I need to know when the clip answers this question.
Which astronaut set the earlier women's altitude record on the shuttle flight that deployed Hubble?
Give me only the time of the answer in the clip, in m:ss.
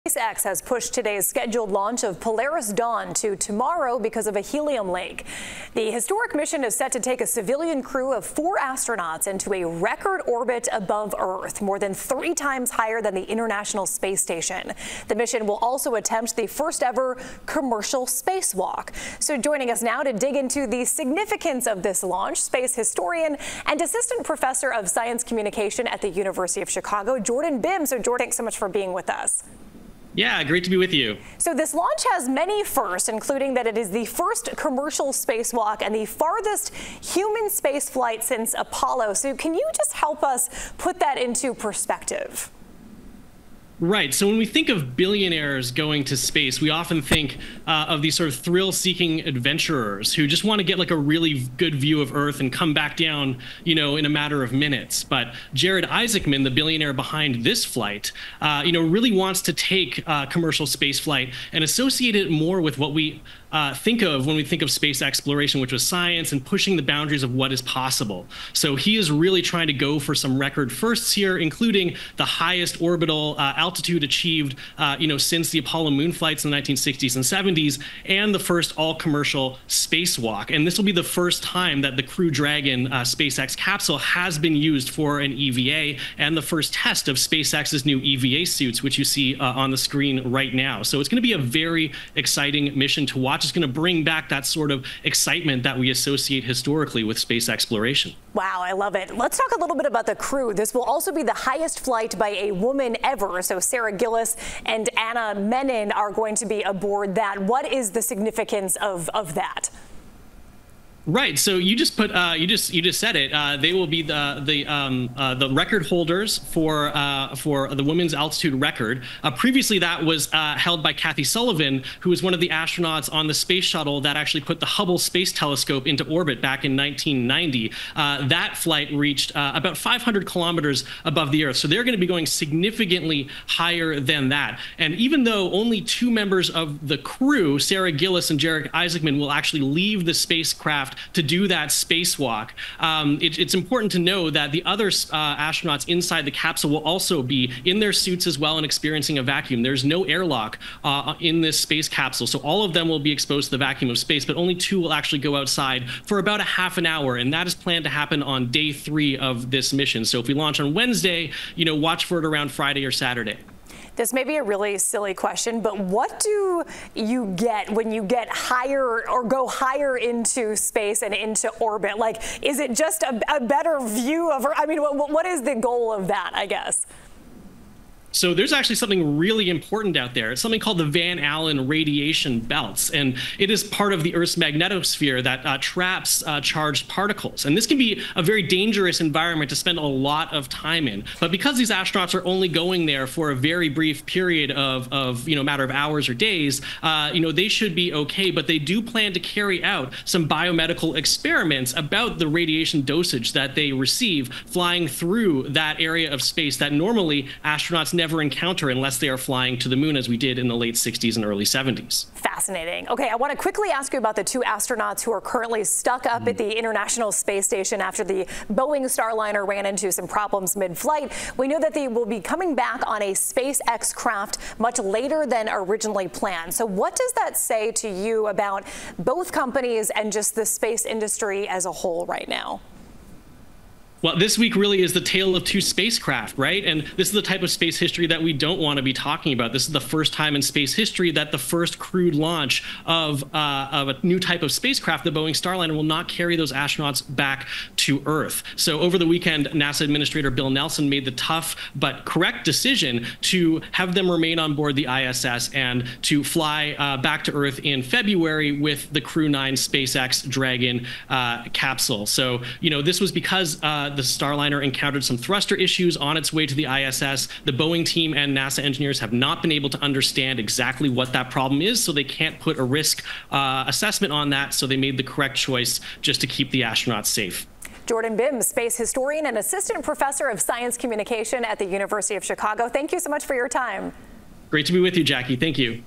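2:00.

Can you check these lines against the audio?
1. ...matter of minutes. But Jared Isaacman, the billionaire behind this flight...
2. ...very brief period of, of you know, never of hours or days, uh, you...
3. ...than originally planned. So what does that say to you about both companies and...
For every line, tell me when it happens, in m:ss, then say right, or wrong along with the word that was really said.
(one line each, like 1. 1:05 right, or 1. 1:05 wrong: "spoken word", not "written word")
1. 0:54 right
2. 3:13 wrong: "matter", not "never"
3. 3:45 right.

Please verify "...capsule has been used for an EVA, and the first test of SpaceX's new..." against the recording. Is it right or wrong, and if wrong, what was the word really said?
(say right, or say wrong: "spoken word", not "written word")
right.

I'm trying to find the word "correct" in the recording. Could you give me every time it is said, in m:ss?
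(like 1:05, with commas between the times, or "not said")
4:12, 4:35.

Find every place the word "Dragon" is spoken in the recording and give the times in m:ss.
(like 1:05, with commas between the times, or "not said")
1:22, 4:20.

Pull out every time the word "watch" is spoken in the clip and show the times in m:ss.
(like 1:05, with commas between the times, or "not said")
1:33, 2:41.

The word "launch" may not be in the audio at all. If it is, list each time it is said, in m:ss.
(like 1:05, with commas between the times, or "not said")
0:01, 0:22, 0:31, 2:40, 4:02.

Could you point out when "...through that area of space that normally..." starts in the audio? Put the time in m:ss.
3:24.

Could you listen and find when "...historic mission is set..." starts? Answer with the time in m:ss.
0:05.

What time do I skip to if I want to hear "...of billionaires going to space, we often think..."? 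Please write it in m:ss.
0:44.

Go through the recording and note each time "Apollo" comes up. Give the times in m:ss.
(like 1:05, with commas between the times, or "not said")
0:38, 1:15.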